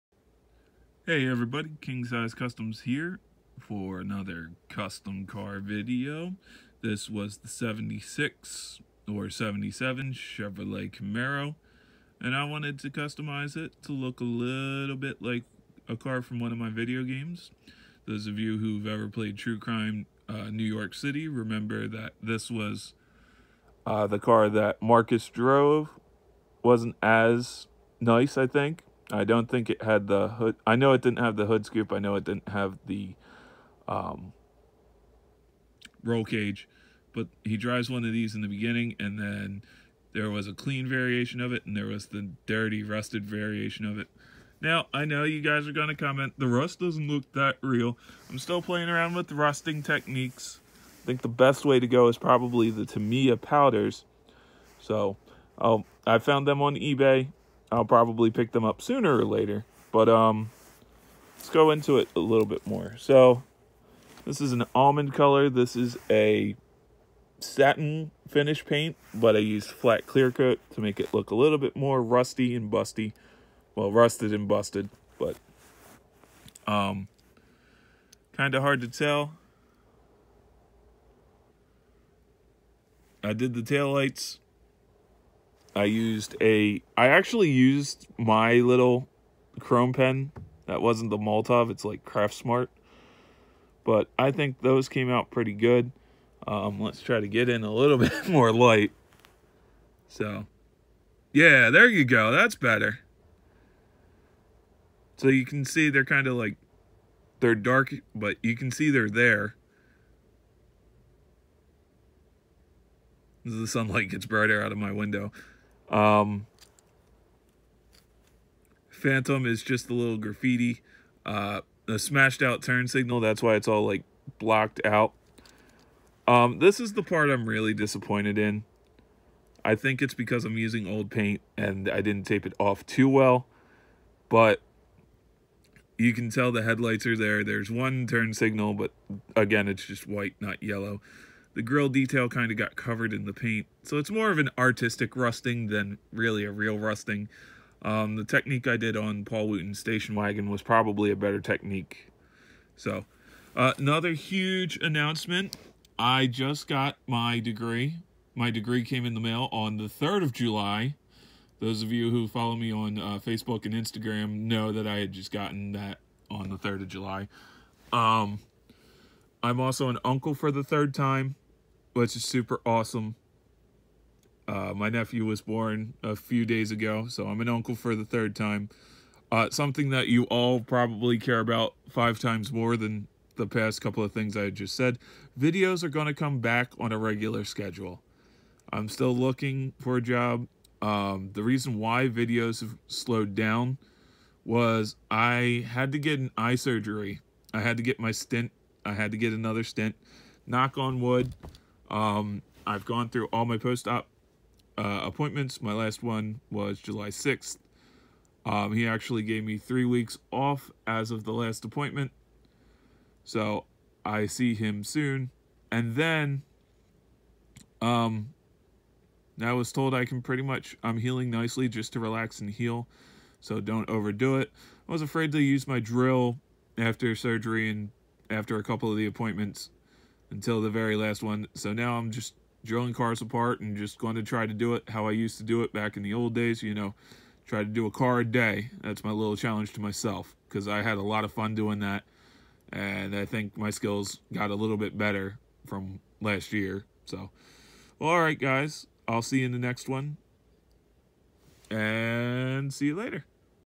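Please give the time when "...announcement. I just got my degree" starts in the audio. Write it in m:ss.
2:34.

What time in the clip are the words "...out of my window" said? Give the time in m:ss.
1:54.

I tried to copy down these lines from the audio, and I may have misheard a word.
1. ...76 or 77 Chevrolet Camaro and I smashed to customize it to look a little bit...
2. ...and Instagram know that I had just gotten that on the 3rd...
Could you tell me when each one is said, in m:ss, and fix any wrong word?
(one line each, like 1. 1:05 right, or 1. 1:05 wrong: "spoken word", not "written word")
1. 0:07 wrong: "wanted", not "smashed"
2. 2:43 right.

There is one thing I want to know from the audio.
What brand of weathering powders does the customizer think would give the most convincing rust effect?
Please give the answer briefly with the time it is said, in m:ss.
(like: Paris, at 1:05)
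Tamiya, at 0:52.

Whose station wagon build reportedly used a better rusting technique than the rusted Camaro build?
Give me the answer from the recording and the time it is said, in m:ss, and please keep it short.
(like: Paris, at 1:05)
Paul Wooten, at 2:29.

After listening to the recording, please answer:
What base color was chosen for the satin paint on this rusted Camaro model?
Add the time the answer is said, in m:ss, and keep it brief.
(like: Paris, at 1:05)
almond, at 1:04.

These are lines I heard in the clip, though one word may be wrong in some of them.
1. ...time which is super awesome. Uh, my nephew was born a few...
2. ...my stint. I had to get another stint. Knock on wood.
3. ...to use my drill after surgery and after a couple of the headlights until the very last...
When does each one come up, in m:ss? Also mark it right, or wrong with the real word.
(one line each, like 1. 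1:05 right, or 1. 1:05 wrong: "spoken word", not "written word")
1. 2:50 right
2. 3:17 right
3. 3:45 wrong: "appointments", not "headlights".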